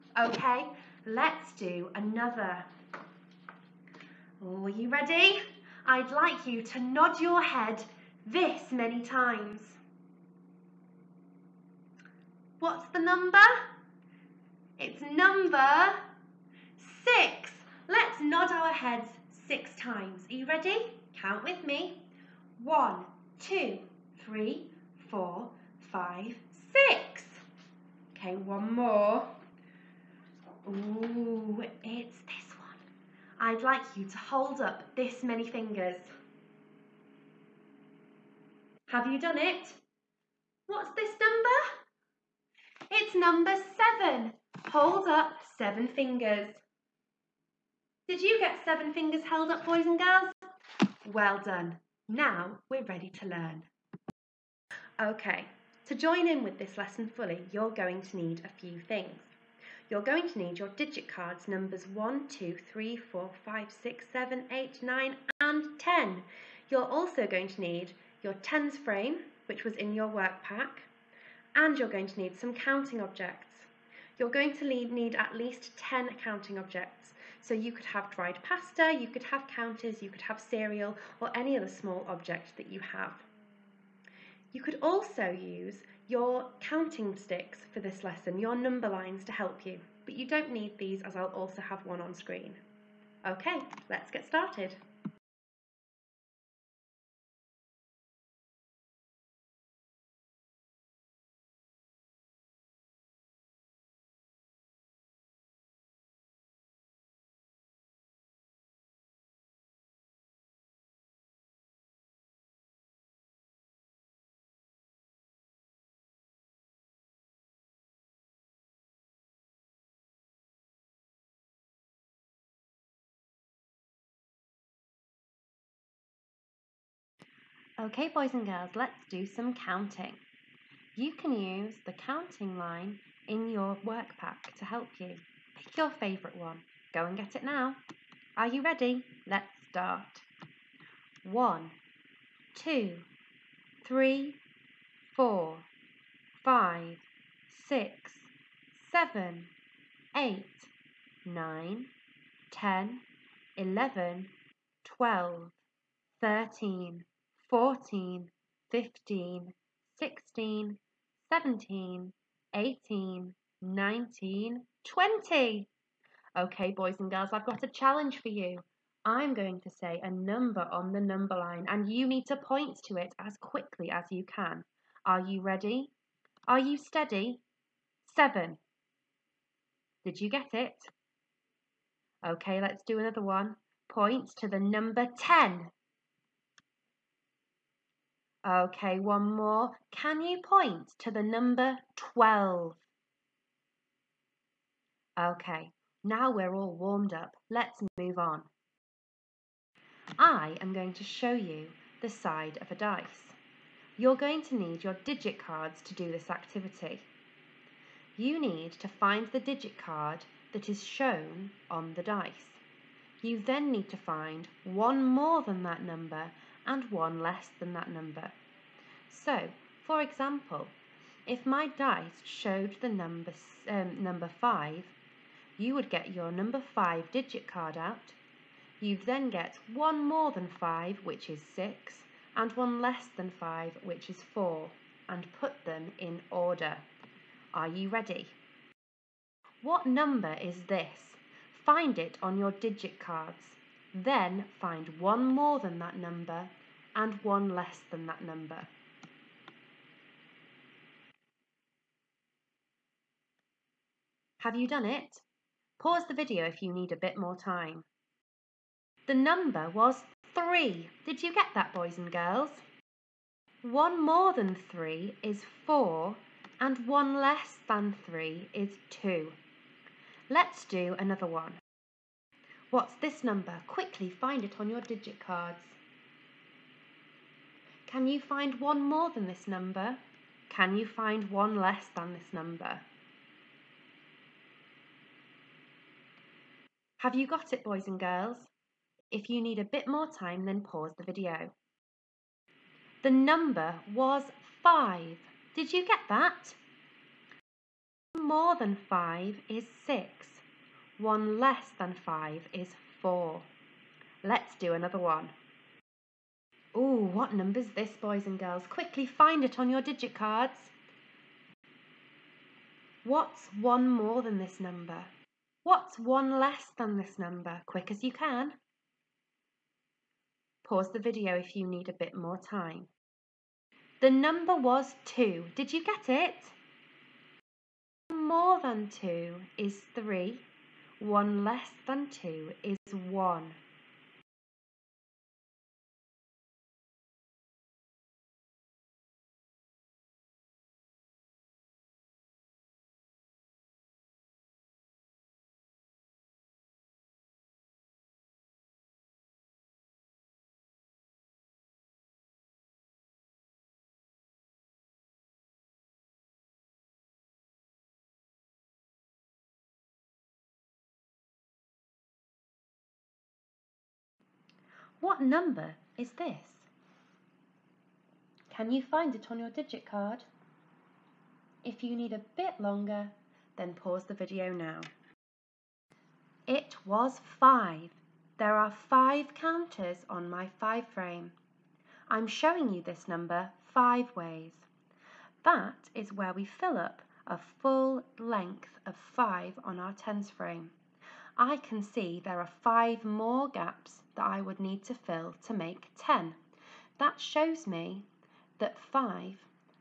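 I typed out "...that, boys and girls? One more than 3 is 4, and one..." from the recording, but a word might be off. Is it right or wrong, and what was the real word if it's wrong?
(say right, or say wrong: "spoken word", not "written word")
right.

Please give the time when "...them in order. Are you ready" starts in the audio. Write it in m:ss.
3:55.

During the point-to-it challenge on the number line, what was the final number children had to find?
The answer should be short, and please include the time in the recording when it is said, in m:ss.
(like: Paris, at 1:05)
12, at 3:11.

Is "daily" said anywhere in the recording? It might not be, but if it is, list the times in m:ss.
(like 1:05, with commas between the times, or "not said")
not said.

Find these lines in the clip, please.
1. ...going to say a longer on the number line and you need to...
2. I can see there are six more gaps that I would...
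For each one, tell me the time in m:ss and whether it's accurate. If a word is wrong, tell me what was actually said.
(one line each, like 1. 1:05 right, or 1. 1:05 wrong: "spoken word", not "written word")
1. 2:49 wrong: "number", not "longer"
2. 6:31 wrong: "five", not "six".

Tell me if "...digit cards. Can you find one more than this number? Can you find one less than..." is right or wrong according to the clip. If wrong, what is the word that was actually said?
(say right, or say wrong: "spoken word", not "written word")
right.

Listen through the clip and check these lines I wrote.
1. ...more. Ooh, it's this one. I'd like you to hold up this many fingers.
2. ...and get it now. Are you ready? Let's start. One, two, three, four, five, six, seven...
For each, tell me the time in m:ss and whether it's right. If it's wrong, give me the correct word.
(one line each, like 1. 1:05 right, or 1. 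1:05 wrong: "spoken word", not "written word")
1. 0:28 right
2. 2:17 right.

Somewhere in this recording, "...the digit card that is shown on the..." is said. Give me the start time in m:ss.
3:29.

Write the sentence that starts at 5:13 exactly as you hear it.
What's one more than this number?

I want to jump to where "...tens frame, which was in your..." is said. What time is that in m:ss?
1:08.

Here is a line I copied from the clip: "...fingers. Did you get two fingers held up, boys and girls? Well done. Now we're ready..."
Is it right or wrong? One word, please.
wrong.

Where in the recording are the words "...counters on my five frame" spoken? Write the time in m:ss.
6:19.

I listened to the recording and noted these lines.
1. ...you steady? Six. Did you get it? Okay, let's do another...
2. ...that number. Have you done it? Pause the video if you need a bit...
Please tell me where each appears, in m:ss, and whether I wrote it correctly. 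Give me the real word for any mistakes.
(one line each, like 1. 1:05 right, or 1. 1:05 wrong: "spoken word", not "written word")
1. 2:56 wrong: "Seven", not "Six"
2. 4:08 right.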